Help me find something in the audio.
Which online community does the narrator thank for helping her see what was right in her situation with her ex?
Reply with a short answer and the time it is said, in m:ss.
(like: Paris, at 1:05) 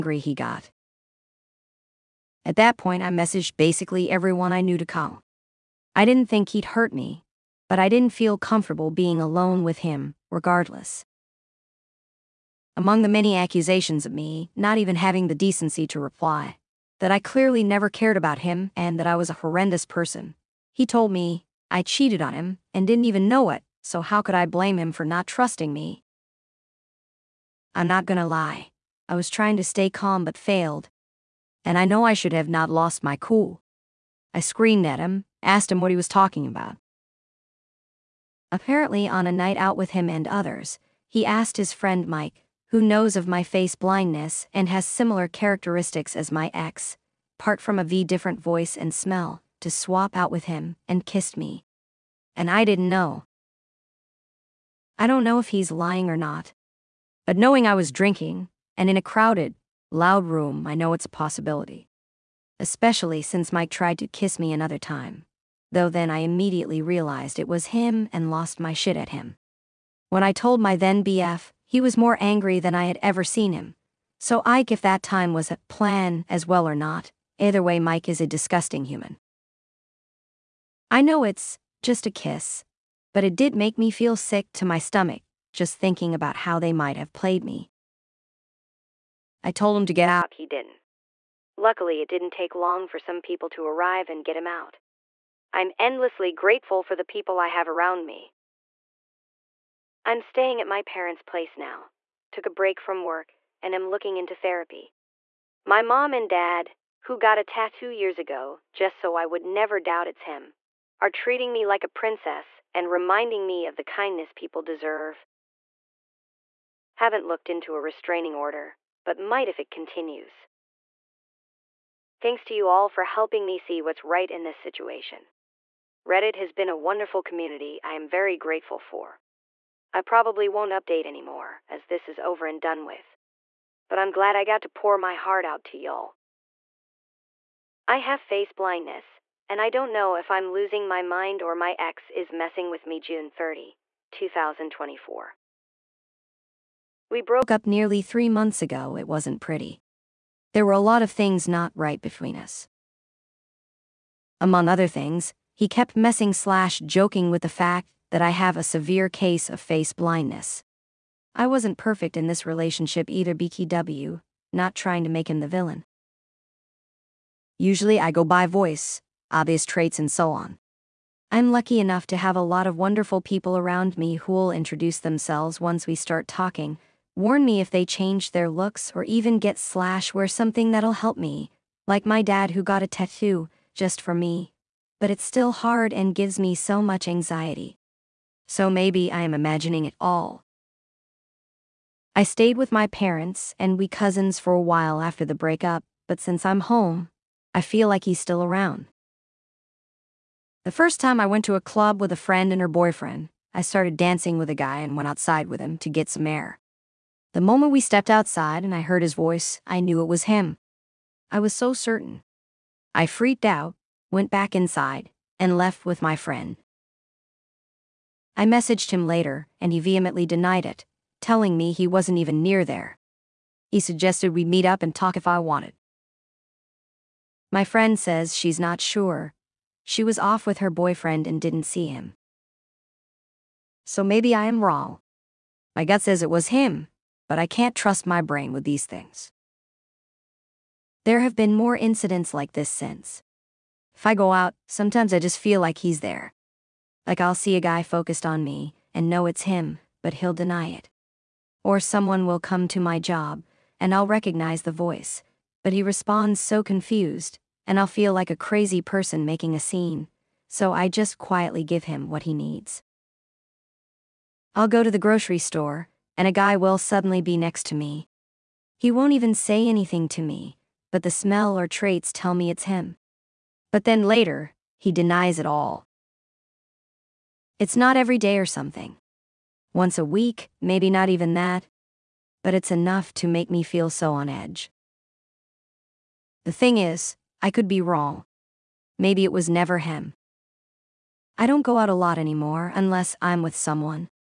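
Reddit, at 2:06.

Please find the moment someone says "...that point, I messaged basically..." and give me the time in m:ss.
0:02.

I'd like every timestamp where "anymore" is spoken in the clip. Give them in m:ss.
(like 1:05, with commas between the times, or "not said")
2:11, 4:52.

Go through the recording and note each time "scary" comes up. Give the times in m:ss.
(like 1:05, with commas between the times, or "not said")
not said.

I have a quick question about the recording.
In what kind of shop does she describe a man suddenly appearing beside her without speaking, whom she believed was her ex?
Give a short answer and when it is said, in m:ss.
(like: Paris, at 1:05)
Grocery store, at 4:24.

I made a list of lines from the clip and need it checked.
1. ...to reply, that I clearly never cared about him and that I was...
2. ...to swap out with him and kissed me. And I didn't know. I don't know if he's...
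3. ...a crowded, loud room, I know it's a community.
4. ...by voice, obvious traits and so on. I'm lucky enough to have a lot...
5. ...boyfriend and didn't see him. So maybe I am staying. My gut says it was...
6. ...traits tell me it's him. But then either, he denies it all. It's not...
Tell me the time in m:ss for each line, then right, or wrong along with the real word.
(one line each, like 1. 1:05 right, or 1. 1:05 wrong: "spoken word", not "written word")
1. 0:15 right
2. 0:49 right
3. 0:58 wrong: "possibility", not "community"
4. 2:48 right
5. 3:50 wrong: "wrong", not "staying"
6. 4:31 wrong: "later", not "either".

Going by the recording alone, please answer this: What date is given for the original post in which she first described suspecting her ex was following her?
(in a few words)
June 30, 2024.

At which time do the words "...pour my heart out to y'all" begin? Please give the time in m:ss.
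2:14.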